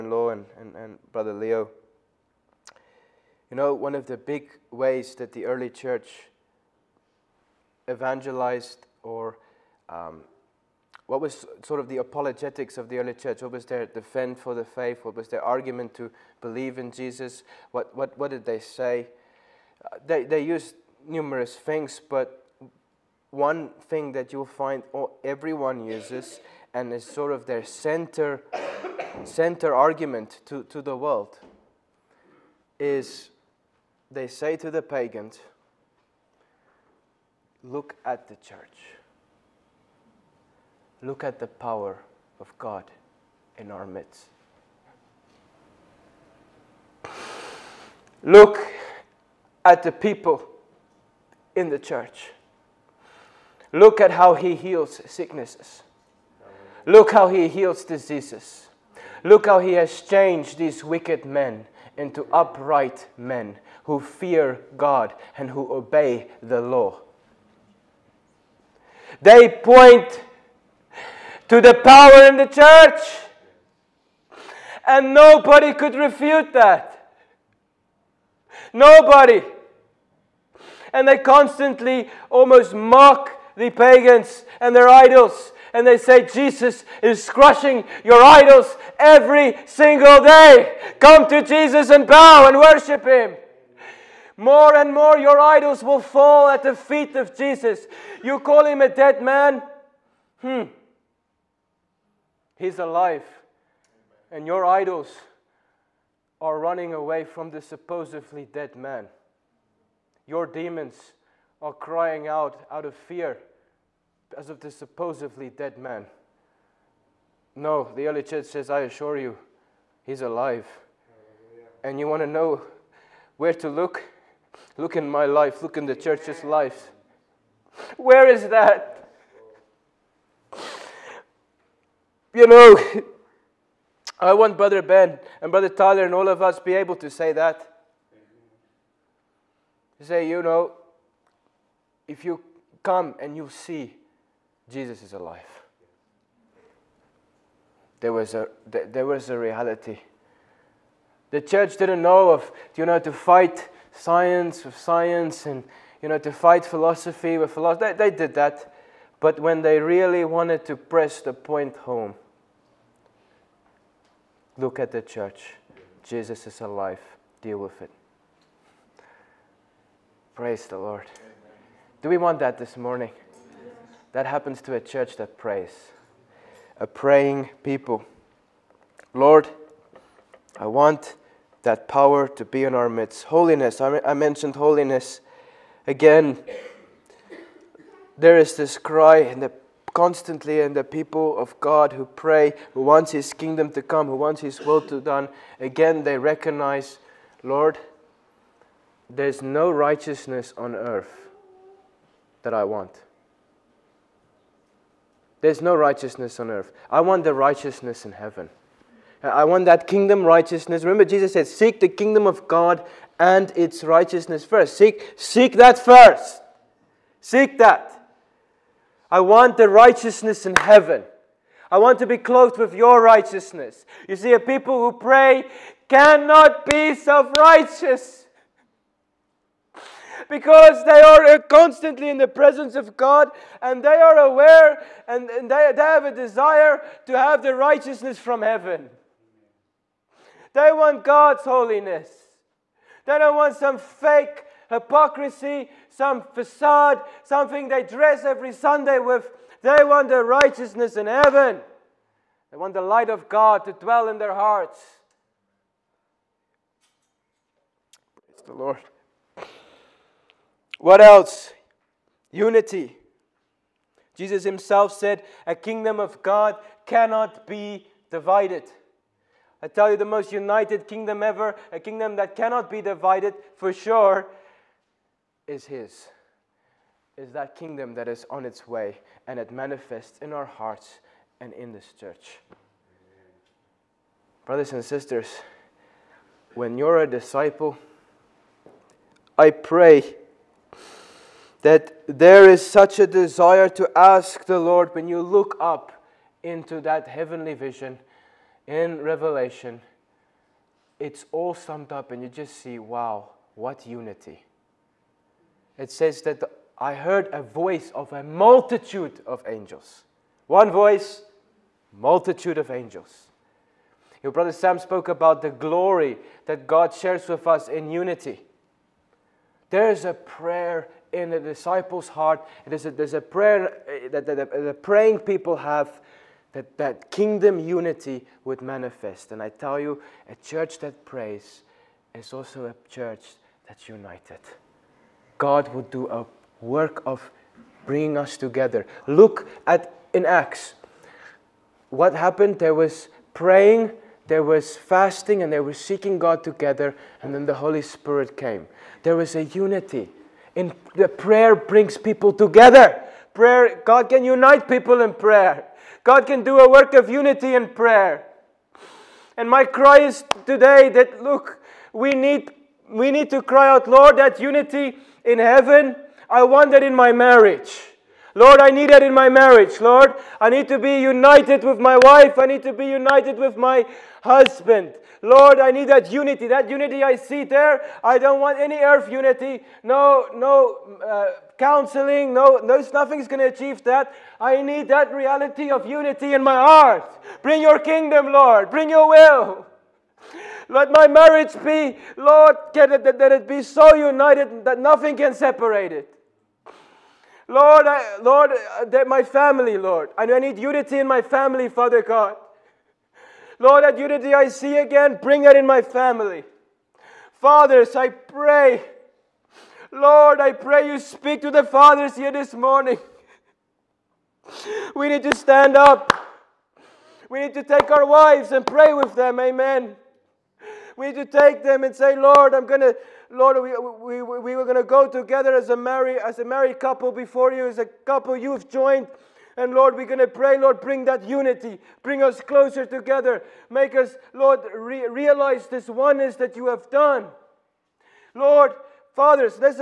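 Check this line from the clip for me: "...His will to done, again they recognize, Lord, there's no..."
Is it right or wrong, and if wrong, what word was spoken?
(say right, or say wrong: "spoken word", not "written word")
right.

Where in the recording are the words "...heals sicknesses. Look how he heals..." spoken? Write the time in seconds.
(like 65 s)
54 s.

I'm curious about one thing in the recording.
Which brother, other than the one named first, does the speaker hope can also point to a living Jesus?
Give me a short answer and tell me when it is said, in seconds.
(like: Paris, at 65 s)
Brother Tyler, at 135 s.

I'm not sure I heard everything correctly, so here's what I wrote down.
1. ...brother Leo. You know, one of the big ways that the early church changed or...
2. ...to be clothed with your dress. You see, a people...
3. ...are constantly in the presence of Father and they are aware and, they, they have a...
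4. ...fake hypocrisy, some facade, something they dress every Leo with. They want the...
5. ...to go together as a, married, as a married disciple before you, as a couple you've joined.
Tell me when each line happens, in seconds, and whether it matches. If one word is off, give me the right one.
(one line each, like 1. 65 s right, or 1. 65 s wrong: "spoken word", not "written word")
1. 1 s wrong: "evangelized", not "changed"
2. 221 s wrong: "righteousness", not "dress"
3. 231 s wrong: "God", not "Father"
4. 243 s wrong: "Sunday", not "Leo"
5. 424 s wrong: "couple", not "disciple".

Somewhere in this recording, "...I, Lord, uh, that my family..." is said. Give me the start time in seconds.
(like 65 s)
397 s.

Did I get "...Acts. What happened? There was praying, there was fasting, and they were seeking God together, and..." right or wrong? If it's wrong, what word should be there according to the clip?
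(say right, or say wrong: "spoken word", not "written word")
right.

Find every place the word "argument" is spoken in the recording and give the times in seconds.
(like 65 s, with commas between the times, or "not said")
15 s, 29 s.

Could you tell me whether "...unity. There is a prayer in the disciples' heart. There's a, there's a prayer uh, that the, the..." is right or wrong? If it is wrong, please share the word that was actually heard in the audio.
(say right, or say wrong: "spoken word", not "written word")
right.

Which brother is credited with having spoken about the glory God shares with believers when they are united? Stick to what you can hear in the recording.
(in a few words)
Brother Sam.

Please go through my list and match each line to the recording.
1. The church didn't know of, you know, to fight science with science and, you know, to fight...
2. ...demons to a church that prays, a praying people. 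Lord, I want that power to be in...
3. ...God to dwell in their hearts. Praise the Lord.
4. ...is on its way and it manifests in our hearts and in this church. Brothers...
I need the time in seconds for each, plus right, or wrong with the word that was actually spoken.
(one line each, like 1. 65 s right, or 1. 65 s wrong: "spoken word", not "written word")
1. 151 s right
2. 174 s wrong: "happens", not "demons"
3. 253 s right
4. 278 s right.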